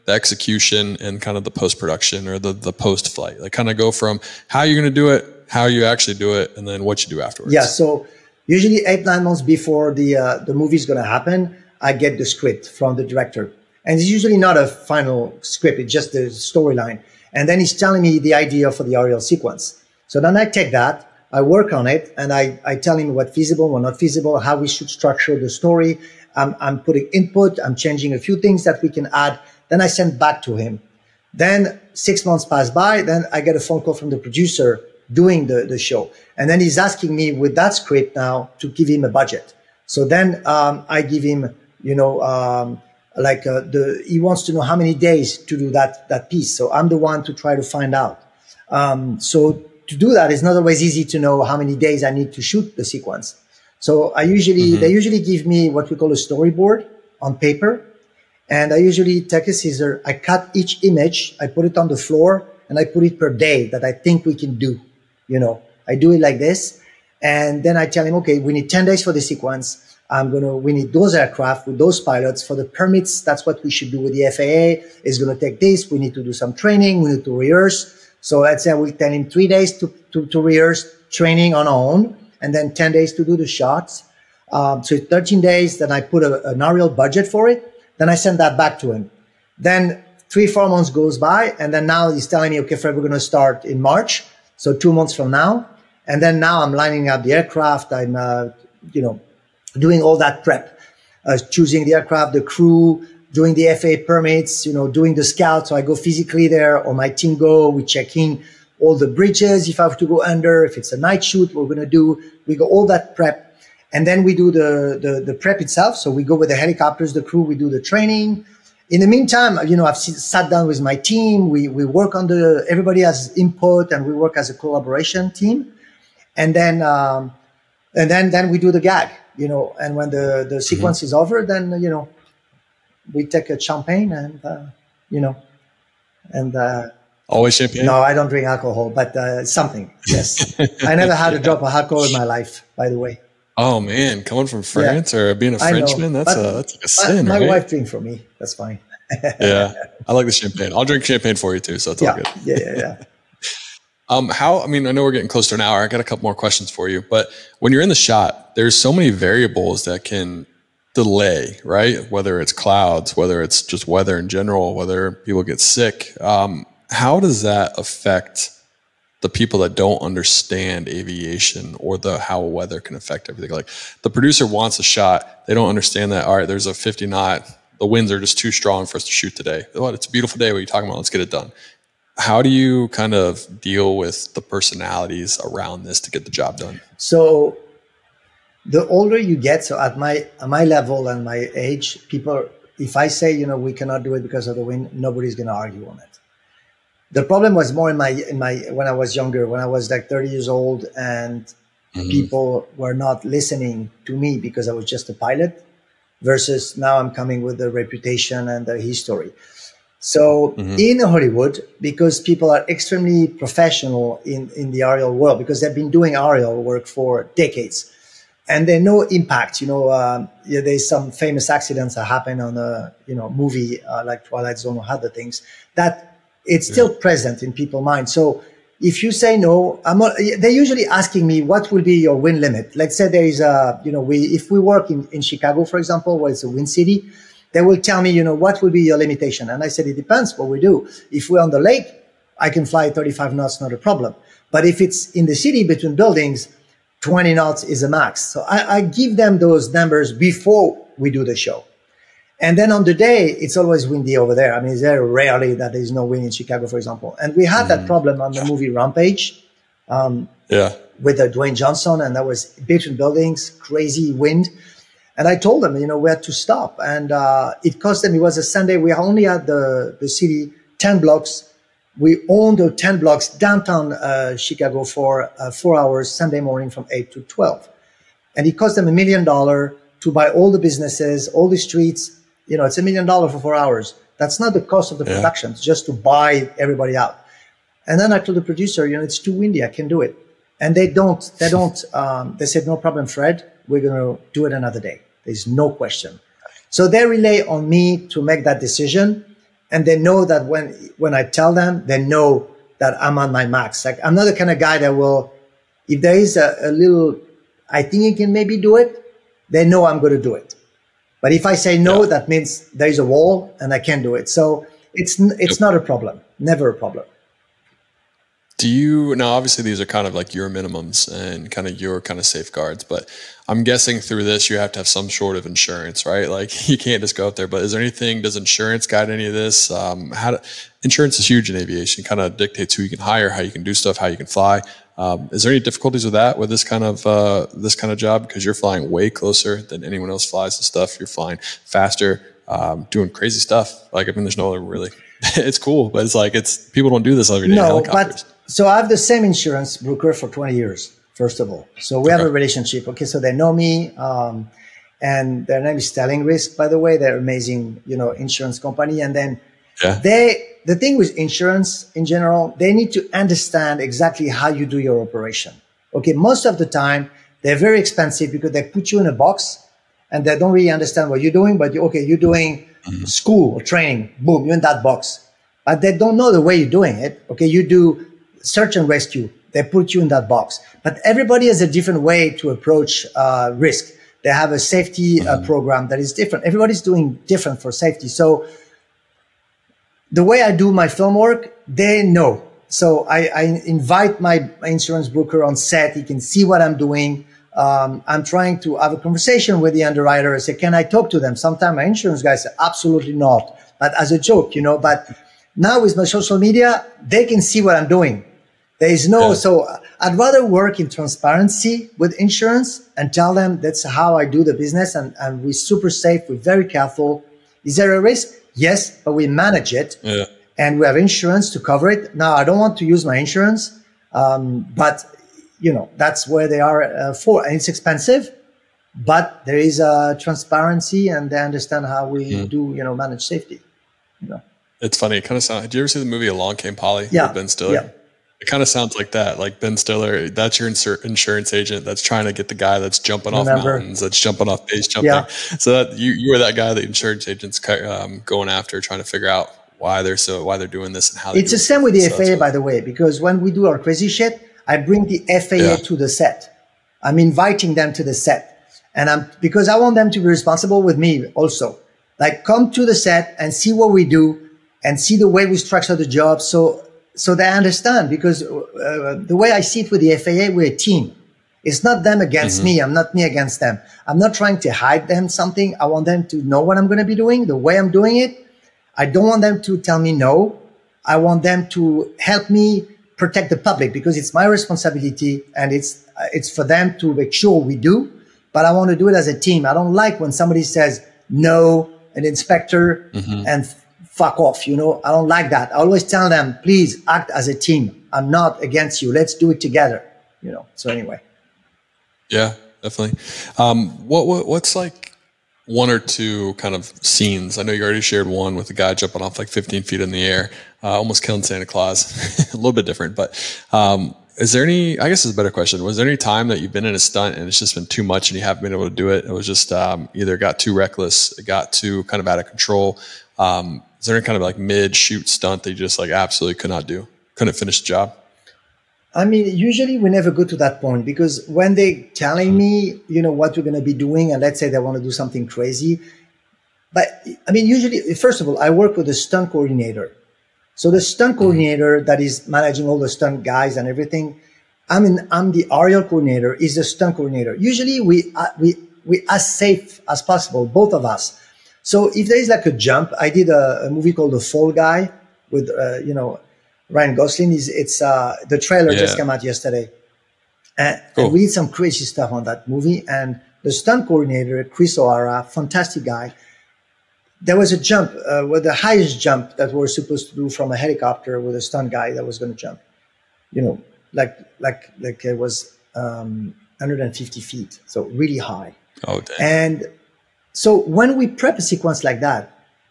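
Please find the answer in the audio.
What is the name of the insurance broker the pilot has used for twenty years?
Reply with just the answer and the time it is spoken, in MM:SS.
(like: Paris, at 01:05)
Sterling Risk, at 05:55.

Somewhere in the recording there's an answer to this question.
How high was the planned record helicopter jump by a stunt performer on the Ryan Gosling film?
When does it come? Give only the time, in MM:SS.
09:36.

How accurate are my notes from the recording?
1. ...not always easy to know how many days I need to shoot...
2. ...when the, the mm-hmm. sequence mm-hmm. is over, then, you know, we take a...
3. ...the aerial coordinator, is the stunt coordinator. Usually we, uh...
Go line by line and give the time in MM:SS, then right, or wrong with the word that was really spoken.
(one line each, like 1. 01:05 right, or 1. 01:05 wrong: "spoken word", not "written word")
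1. 00:50 right
2. 02:09 right
3. 09:05 right.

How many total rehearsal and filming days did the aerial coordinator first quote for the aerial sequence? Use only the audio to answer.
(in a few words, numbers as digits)
13.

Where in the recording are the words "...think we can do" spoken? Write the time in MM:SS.
01:03.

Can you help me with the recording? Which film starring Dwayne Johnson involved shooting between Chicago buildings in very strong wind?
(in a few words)
Rampage.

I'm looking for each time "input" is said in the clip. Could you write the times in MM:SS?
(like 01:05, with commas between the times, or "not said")
00:27, 02:03.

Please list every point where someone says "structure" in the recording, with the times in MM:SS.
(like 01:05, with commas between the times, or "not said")
00:24, 07:45.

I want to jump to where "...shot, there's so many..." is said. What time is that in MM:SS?
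02:37.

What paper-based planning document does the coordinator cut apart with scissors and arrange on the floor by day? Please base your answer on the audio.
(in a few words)
storyboard.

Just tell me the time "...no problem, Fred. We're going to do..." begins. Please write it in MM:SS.
04:52.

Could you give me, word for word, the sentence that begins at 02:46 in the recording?
Um, how does that affect the people that don't understand aviation or the how weather can affect everything?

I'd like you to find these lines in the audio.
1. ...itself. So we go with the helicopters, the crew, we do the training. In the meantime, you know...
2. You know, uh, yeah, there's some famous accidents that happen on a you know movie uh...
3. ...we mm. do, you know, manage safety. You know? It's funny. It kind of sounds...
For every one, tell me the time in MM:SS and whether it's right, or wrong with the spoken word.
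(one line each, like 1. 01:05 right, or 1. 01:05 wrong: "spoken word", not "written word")
1. 01:55 right
2. 03:39 right
3. 07:12 right.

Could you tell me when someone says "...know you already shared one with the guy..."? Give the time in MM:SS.
08:27.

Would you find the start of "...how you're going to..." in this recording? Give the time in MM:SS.
00:04.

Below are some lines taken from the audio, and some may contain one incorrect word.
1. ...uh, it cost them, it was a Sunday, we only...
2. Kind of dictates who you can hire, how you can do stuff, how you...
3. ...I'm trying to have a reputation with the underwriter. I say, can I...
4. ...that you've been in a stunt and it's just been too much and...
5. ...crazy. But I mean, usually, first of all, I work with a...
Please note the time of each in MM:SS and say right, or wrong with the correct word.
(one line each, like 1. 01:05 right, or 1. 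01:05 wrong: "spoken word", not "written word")
1. 04:27 right
2. 05:32 right
3. 06:38 wrong: "conversation", not "reputation"
4. 08:36 right
5. 08:55 right.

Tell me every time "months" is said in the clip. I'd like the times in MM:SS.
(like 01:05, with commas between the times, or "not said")
00:09, 00:32, 01:30, 01:34.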